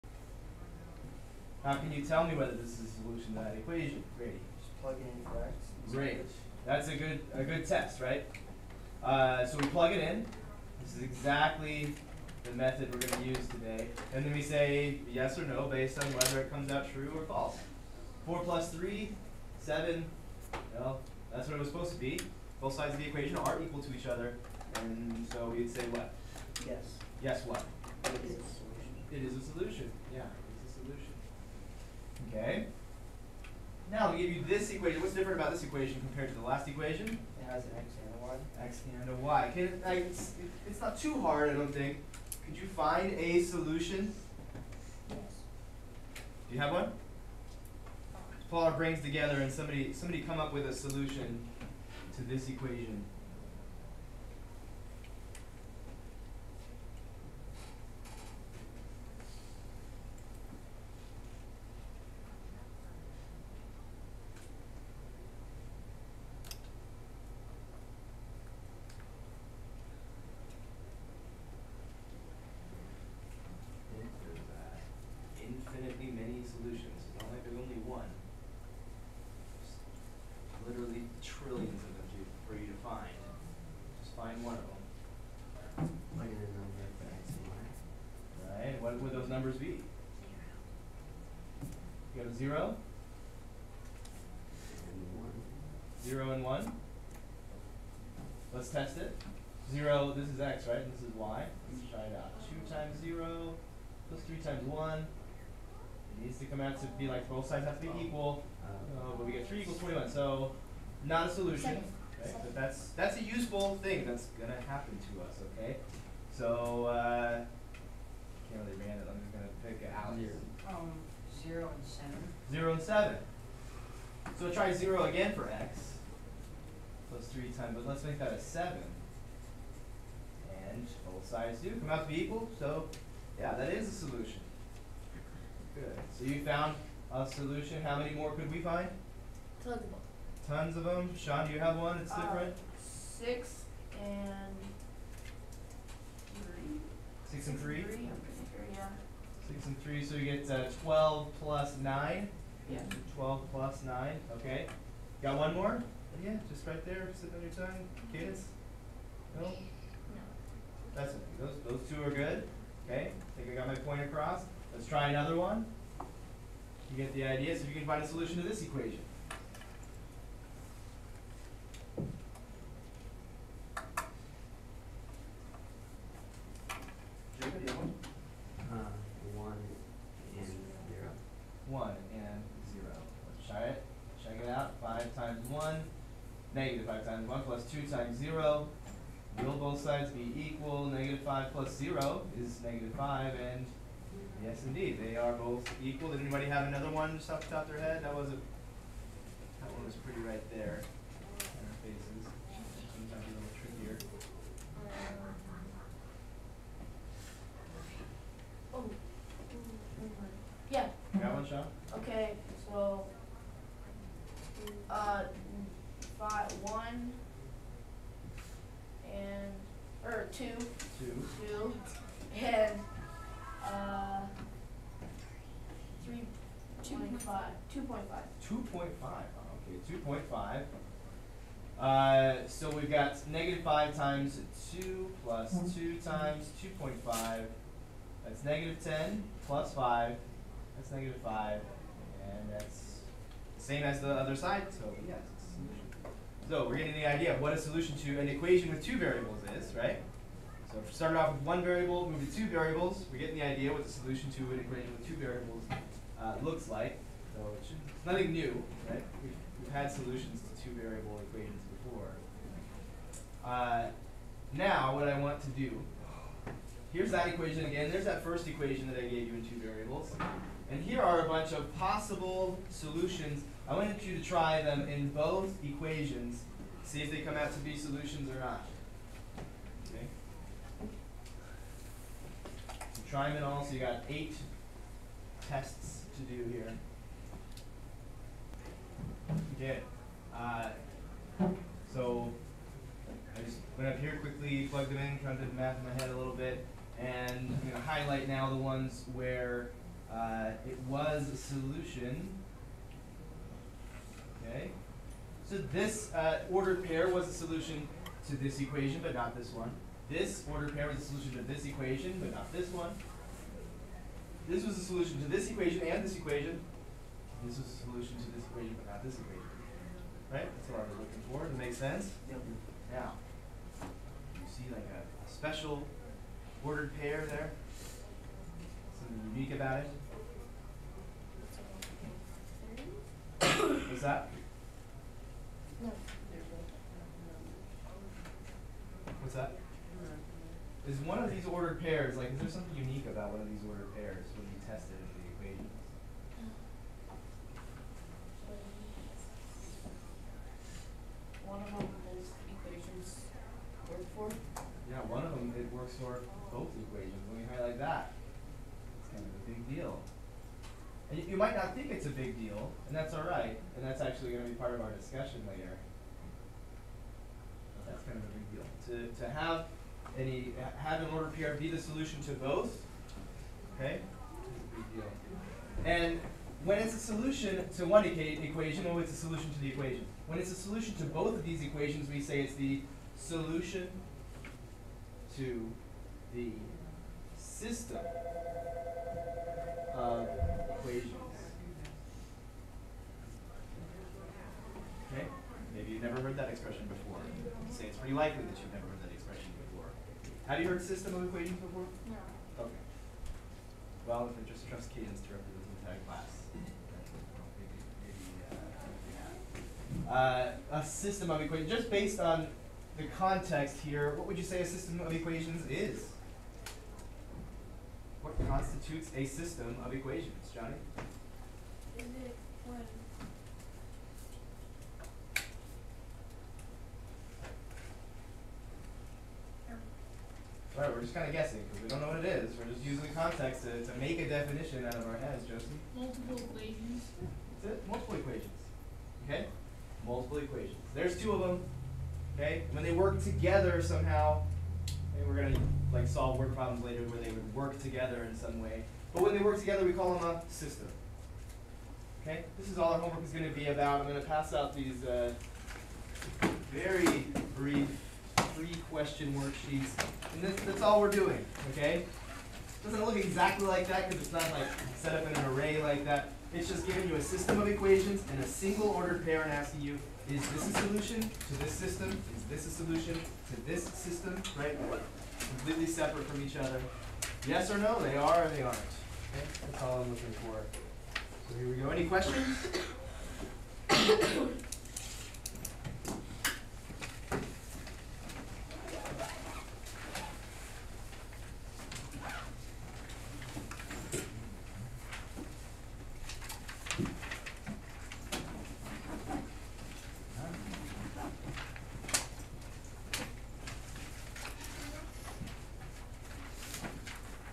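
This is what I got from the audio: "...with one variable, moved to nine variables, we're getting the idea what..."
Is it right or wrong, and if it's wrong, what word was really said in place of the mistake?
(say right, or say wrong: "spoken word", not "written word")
wrong: "two", not "nine".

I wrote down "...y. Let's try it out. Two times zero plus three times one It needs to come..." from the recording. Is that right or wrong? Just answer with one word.
right.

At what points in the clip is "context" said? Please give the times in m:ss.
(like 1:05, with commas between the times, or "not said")
6:53, 7:13.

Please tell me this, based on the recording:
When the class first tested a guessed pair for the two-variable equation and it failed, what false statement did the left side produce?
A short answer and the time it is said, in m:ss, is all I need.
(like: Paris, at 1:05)
3 equals 21, at 1:49.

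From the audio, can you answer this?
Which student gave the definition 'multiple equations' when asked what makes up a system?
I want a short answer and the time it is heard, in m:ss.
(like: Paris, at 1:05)
Josie, at 7:15.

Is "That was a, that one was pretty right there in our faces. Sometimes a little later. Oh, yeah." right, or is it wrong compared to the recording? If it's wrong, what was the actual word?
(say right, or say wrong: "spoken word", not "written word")
wrong: "trickier", not "later".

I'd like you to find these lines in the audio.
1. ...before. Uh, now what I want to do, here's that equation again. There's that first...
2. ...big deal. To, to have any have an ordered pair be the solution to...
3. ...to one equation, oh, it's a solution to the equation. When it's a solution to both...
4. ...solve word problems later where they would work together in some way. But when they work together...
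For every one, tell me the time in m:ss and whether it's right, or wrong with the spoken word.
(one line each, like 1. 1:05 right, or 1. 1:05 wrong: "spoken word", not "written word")
1. 4:21 right
2. 6:08 right
3. 6:17 right
4. 7:26 right.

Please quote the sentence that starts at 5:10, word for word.
This ordered pair was a solution to this equation, but not this one.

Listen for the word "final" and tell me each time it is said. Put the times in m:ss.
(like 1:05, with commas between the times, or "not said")
not said.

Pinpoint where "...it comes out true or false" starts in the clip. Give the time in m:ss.
0:16.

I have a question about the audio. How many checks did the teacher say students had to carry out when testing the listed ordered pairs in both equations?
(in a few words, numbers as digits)
8.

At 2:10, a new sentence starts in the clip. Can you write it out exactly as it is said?
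And both sides do come out to be equal.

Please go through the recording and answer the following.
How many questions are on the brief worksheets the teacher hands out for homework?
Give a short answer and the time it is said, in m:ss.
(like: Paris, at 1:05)
3, at 7:38.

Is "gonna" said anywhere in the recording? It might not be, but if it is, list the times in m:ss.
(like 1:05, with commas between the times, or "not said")
1:54, 1:59.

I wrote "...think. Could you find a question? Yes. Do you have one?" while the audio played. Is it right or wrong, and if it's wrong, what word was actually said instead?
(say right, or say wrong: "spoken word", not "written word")
wrong: "solution", not "question".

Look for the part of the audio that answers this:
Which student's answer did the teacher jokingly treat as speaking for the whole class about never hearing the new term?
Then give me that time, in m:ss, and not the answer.
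6:44.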